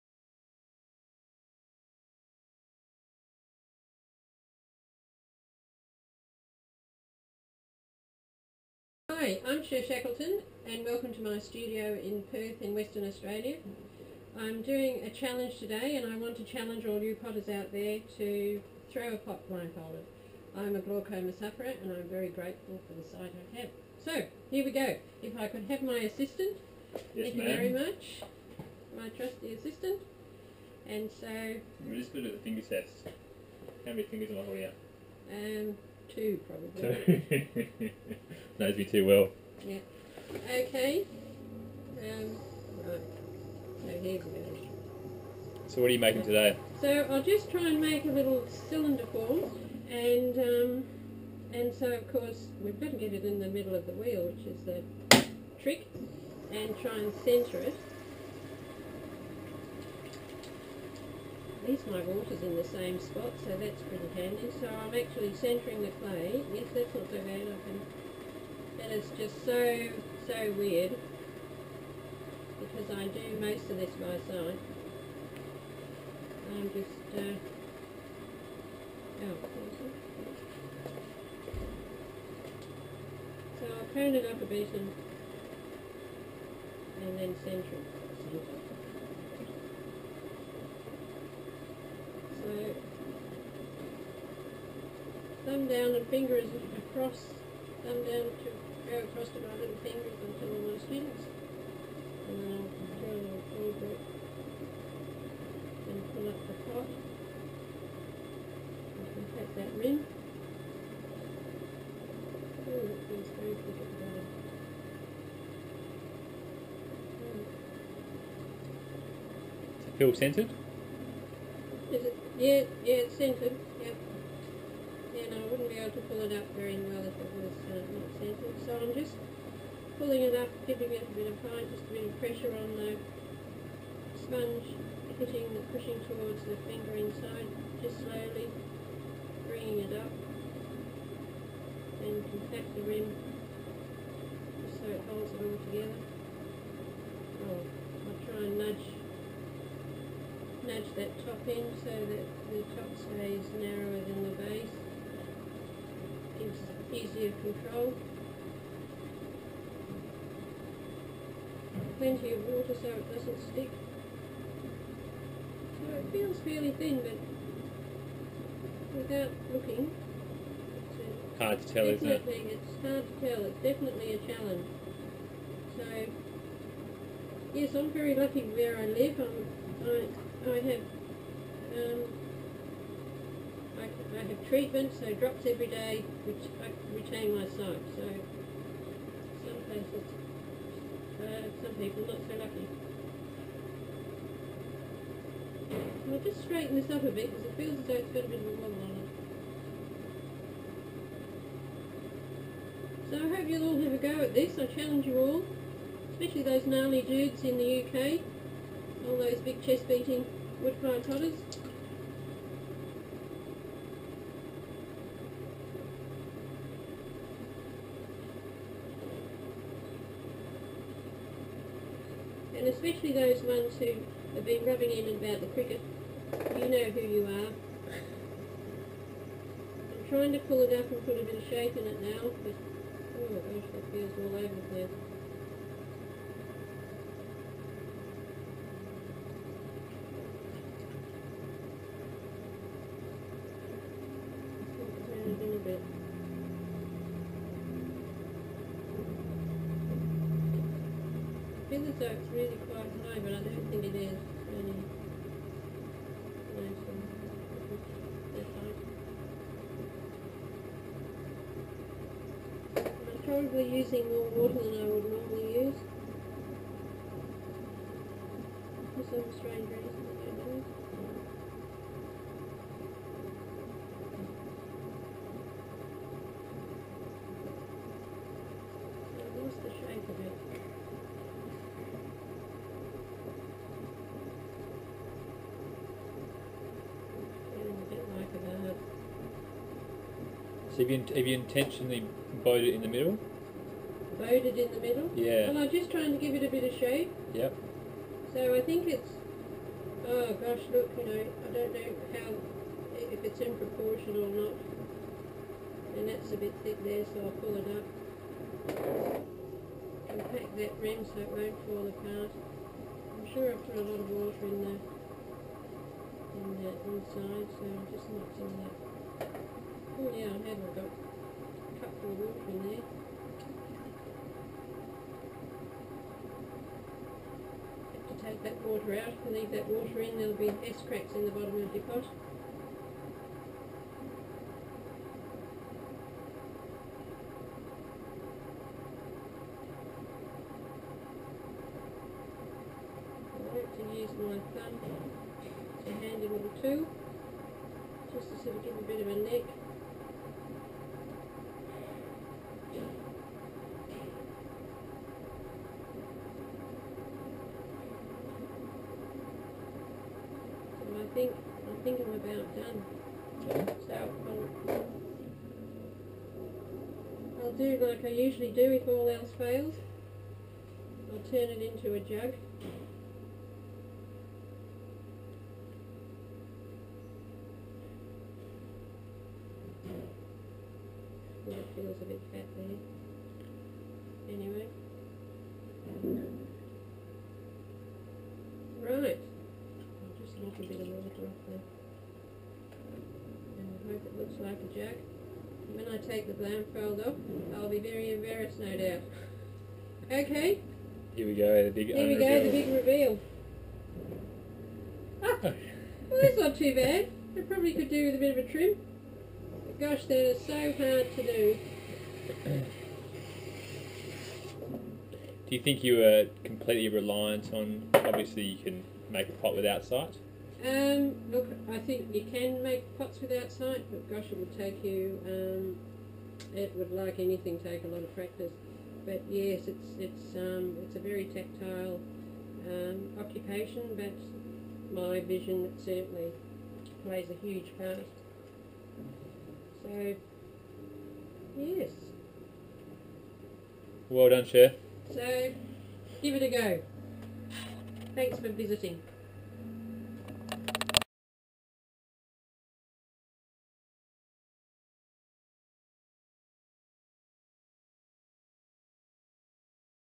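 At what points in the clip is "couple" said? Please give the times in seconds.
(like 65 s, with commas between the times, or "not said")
321 s.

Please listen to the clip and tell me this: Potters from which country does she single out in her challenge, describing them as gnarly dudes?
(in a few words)
UK.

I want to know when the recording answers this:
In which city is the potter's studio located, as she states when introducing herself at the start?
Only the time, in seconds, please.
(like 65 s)
12 s.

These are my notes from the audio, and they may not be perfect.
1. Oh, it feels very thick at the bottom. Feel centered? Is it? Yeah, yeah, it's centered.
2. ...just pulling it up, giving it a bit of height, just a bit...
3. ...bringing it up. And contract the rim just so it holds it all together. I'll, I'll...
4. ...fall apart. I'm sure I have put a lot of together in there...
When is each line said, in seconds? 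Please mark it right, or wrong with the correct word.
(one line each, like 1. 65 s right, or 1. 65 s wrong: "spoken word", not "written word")
1. 112 s right
2. 128 s right
3. 139 s right
4. 311 s wrong: "water", not "together".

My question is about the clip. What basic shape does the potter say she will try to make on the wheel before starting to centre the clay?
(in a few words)
little cylinder.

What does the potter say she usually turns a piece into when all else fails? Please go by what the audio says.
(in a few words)
a jug.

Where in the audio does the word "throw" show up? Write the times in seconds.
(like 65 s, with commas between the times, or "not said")
18 s, 103 s.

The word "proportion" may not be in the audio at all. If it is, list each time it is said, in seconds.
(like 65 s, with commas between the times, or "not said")
303 s.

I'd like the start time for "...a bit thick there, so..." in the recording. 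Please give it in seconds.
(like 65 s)
306 s.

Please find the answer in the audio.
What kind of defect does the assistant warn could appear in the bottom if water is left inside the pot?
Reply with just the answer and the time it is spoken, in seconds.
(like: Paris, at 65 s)
s-cracks, at 330 s.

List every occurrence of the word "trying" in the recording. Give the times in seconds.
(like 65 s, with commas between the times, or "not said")
230 s, 295 s.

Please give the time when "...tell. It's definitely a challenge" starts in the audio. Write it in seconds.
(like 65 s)
173 s.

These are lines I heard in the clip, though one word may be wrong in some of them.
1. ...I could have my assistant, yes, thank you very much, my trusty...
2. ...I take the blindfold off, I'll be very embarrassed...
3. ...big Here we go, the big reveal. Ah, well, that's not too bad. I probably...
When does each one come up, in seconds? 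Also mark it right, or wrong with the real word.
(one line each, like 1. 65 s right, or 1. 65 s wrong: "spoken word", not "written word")
1. 25 s right
2. 395 s right
3. 401 s right.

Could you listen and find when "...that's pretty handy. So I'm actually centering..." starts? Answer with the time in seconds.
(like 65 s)
63 s.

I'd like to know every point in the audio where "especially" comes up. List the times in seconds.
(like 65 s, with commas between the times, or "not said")
206 s, 222 s.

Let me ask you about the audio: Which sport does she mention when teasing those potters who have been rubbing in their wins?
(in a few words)
cricket.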